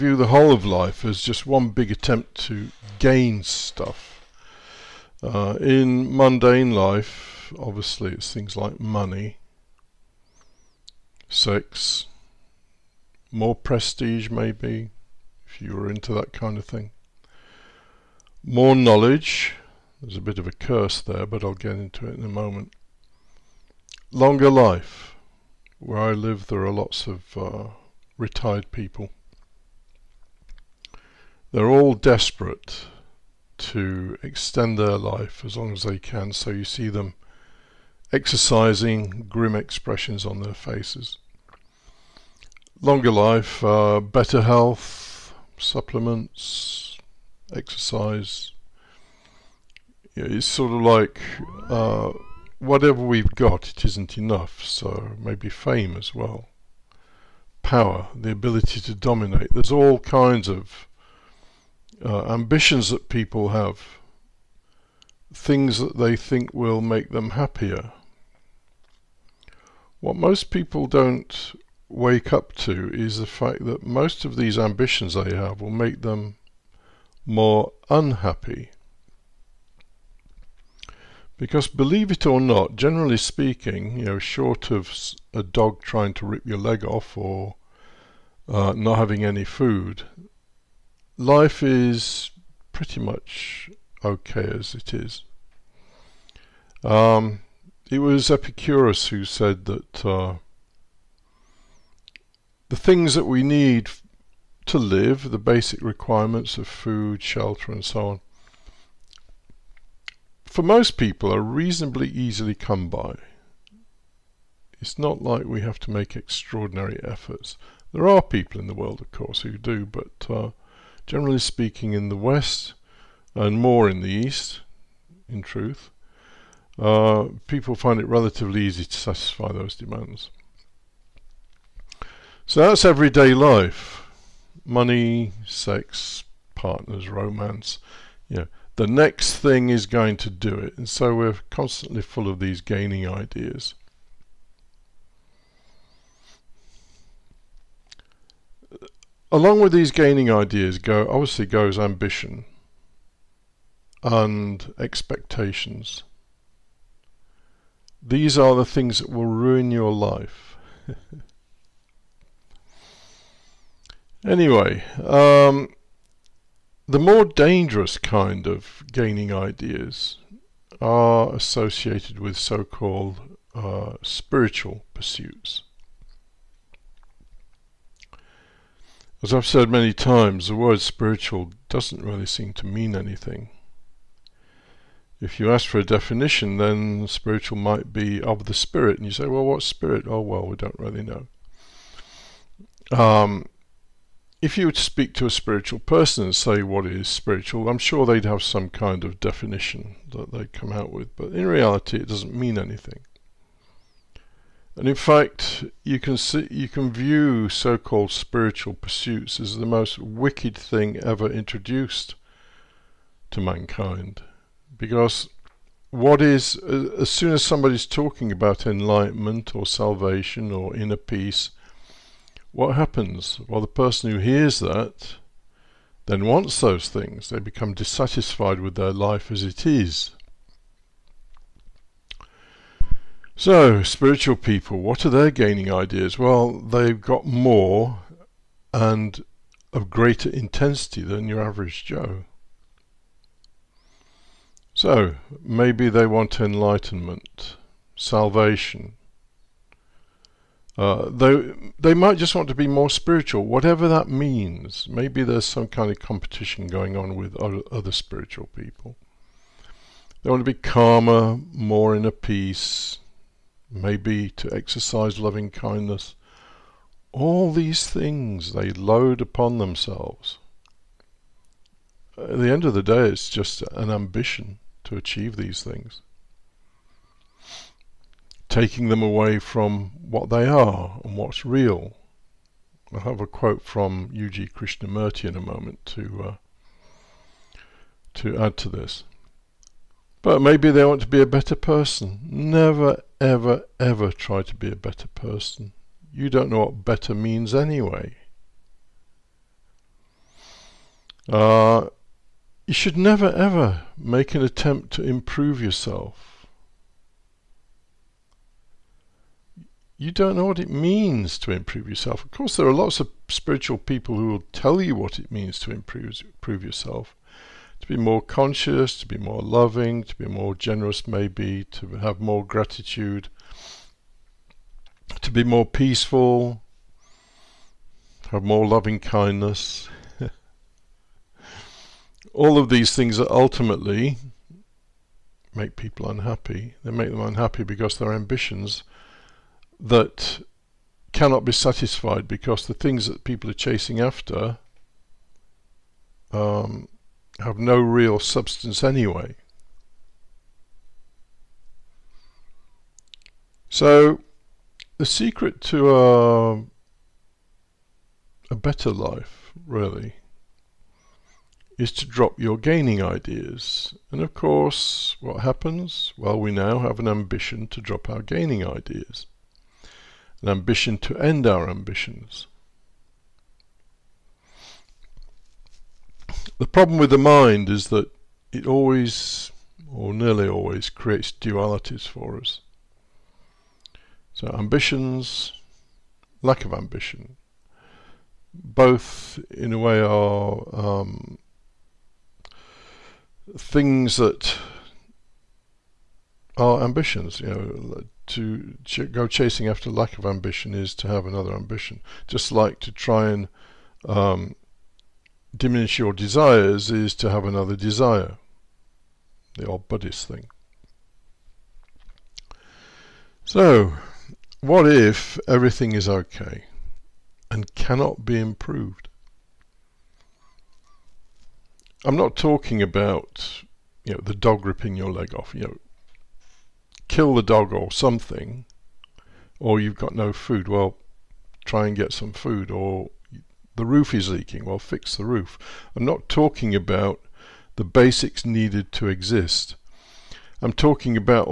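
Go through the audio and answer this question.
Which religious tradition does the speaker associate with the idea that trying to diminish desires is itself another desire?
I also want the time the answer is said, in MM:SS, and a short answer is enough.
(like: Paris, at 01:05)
Buddhist, at 06:49.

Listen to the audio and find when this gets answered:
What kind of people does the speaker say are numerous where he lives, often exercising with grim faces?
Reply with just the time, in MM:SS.
00:28.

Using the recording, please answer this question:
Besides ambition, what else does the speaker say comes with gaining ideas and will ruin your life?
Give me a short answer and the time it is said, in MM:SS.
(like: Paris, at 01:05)
Expectations, at 02:34.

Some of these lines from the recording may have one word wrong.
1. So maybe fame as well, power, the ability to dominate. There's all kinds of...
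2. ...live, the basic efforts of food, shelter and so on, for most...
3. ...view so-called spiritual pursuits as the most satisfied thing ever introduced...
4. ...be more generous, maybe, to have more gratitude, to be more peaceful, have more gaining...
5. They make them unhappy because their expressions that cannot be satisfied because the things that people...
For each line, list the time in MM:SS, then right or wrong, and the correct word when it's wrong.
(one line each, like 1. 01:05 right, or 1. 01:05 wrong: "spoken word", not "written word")
1. 00:54 right
2. 01:44 wrong: "requirements", not "efforts"
3. 03:26 wrong: "wicked", not "satisfied"
4. 05:20 wrong: "loving", not "gaining"
5. 05:36 wrong: "ambitions", not "expressions".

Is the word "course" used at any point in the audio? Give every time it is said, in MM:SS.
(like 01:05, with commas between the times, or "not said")
01:59, 05:12, 06:04.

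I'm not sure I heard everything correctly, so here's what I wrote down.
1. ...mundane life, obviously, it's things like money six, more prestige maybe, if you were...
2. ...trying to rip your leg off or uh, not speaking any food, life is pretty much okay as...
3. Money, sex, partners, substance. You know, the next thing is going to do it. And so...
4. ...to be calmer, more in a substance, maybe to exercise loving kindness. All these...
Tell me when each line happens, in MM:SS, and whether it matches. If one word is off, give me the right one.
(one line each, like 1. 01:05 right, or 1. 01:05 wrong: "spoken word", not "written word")
1. 00:06 right
2. 01:25 wrong: "having", not "speaking"
3. 02:14 wrong: "romance", not "substance"
4. 04:20 wrong: "peace", not "substance".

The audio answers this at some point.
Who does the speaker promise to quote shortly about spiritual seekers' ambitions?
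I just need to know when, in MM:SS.
04:44.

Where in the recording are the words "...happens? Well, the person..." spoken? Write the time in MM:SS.
03:42.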